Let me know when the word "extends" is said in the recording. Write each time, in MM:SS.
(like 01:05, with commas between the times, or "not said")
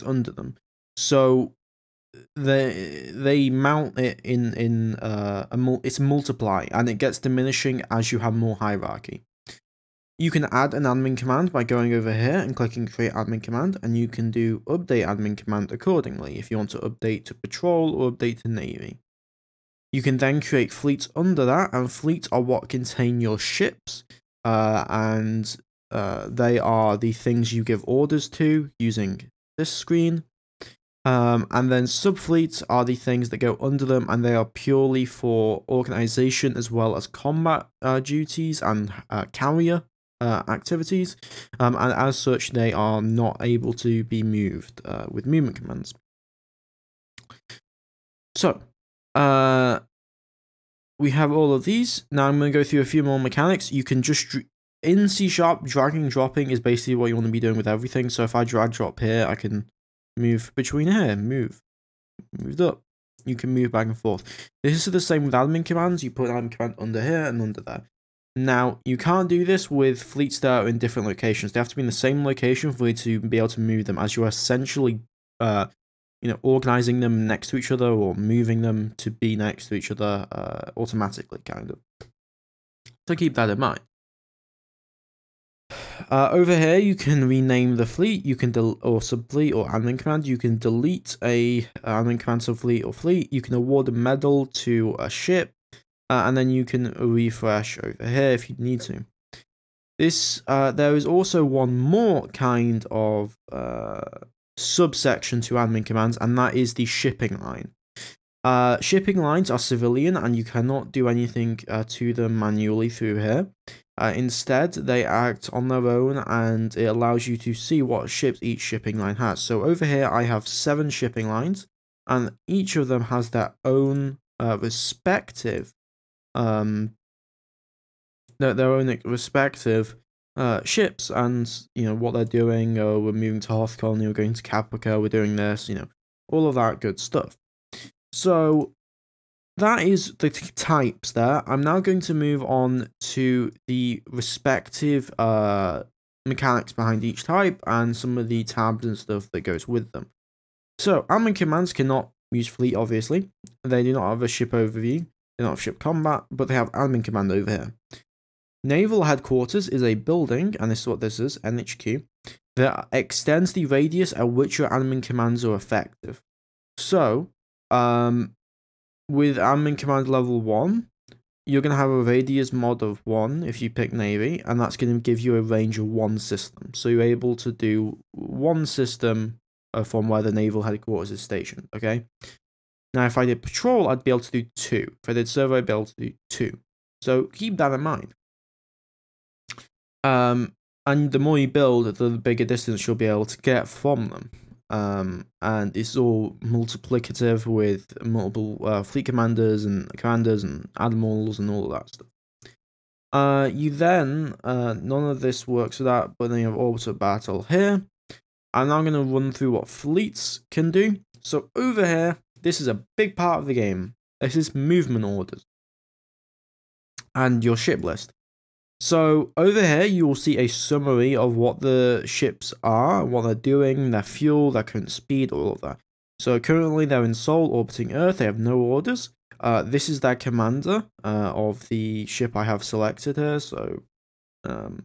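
02:42.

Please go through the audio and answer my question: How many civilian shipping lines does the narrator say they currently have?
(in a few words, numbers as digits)
7.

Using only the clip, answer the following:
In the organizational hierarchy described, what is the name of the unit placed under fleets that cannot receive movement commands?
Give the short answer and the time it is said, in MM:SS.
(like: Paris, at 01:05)
Subfleets, at 00:31.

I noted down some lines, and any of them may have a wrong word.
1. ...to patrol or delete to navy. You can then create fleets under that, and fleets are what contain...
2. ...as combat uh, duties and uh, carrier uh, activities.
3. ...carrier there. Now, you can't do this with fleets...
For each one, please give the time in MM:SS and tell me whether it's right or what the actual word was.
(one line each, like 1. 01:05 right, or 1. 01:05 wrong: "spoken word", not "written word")
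1. 00:17 wrong: "update", not "delete"
2. 00:36 right
3. 01:07 wrong: "under", not "carrier".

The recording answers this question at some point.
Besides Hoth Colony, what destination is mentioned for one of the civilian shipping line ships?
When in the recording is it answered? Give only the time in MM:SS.
02:14.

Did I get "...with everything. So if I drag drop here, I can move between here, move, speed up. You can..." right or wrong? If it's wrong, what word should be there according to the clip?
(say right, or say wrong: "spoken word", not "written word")
wrong: "moved", not "speed".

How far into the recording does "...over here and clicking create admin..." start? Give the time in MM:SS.
00:11.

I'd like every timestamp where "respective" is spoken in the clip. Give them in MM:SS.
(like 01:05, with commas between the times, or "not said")
02:04, 02:09, 02:24.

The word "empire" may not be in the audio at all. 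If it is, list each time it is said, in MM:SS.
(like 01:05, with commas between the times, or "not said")
not said.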